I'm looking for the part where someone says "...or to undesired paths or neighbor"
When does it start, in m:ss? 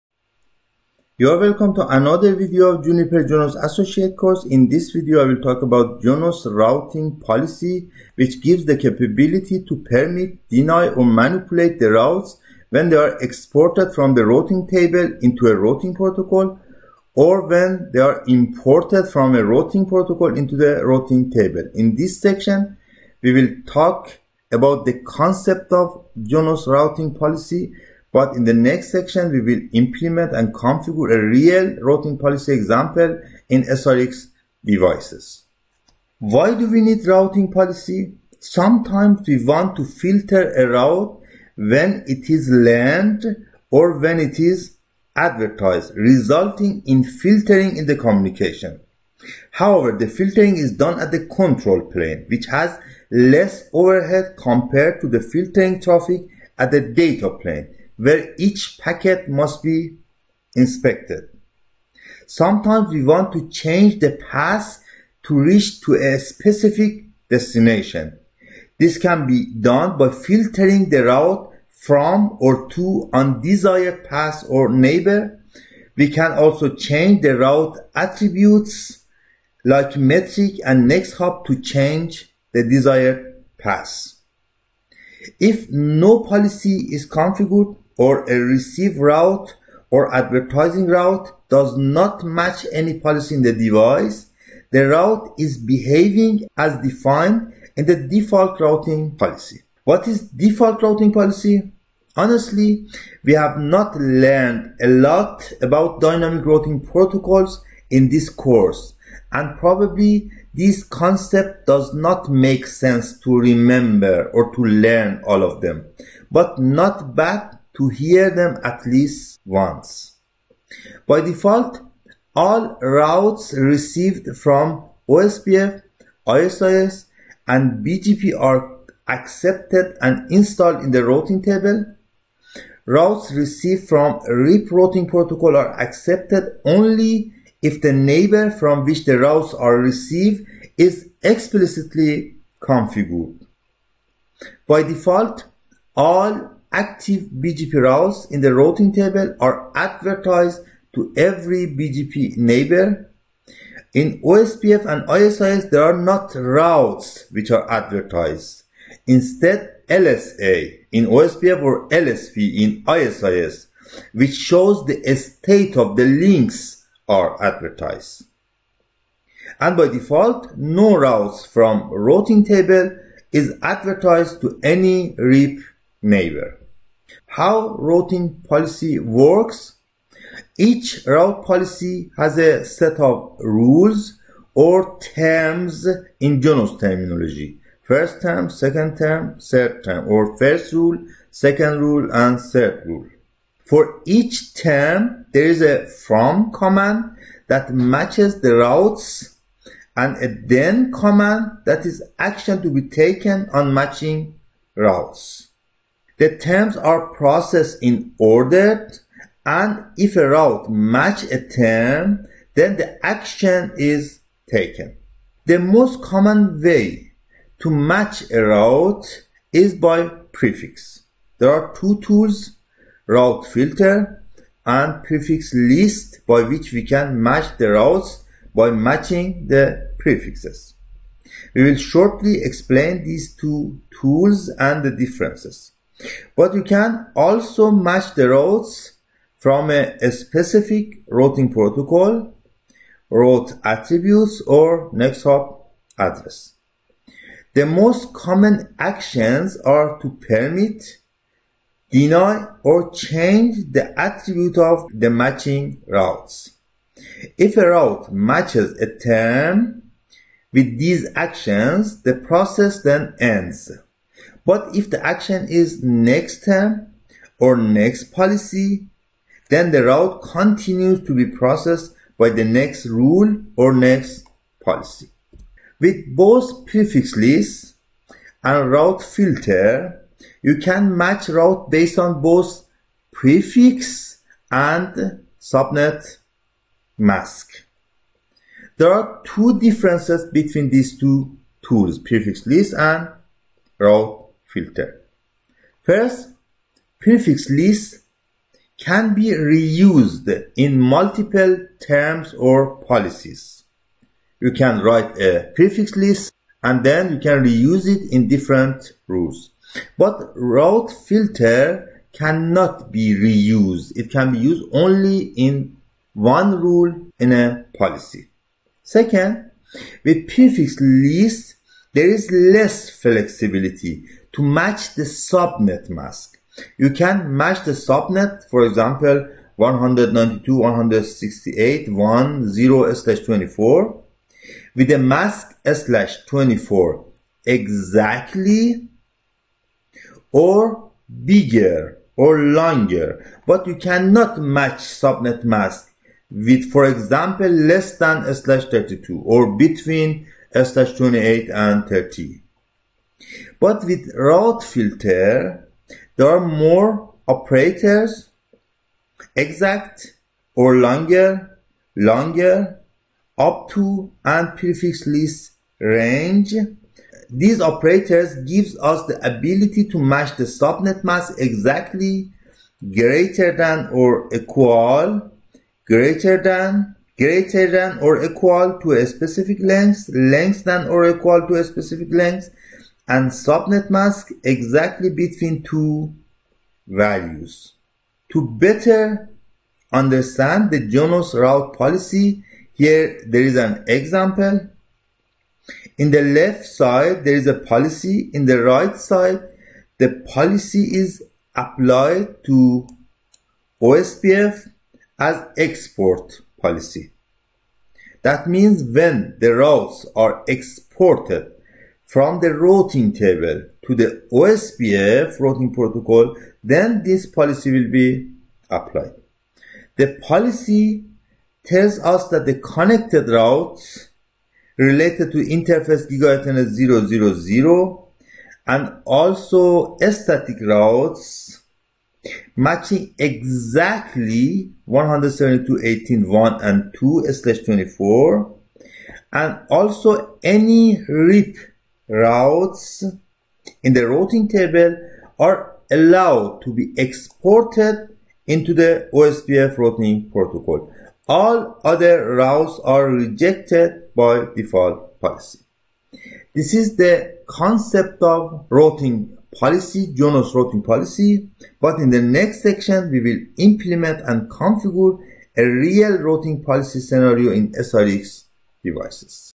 1:12.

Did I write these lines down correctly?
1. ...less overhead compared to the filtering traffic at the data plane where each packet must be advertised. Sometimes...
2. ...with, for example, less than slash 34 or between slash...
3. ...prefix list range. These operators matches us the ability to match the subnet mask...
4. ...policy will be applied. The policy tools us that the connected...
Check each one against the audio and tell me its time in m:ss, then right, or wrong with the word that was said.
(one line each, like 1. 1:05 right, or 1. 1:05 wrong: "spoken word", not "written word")
1. 0:53 wrong: "inspected", not "advertised"
2. 5:46 wrong: "32", not "34"
3. 6:04 wrong: "gives", not "matches"
4. 6:57 wrong: "tells", not "tools".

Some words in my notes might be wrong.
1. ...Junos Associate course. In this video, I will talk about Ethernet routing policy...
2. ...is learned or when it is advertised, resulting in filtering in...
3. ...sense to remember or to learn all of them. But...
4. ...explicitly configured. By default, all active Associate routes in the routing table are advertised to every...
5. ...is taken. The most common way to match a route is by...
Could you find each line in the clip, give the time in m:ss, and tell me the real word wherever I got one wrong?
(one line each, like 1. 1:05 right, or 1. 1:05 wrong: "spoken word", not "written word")
1. 0:03 wrong: "Junos", not "Ethernet"
2. 0:42 right
3. 1:52 right
4. 2:21 wrong: "BGP", not "Associate"
5. 3:33 right.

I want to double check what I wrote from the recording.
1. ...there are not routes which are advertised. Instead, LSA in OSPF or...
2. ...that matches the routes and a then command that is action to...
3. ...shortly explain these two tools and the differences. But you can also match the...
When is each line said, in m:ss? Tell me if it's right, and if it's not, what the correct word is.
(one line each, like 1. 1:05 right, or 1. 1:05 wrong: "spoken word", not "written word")
1. 2:35 right
2. 3:17 right
3. 3:51 right.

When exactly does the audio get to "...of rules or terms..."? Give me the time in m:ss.
3:02.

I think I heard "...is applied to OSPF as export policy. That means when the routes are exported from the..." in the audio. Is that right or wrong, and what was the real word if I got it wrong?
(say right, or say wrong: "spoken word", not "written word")
right.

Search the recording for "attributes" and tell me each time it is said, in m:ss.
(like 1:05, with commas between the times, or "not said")
1:17, 4:03, 4:13.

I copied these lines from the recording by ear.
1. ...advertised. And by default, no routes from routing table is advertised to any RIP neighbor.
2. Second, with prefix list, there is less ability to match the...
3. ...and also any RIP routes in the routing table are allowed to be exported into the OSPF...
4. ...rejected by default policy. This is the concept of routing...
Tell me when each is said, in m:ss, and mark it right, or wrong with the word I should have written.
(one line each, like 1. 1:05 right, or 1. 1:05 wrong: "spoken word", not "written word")
1. 2:47 right
2. 5:18 wrong: "flexibility", not "ability"
3. 7:19 right
4. 7:33 right.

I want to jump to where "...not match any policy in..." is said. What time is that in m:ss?
1:31.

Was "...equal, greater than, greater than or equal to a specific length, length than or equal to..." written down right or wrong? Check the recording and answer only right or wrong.
right.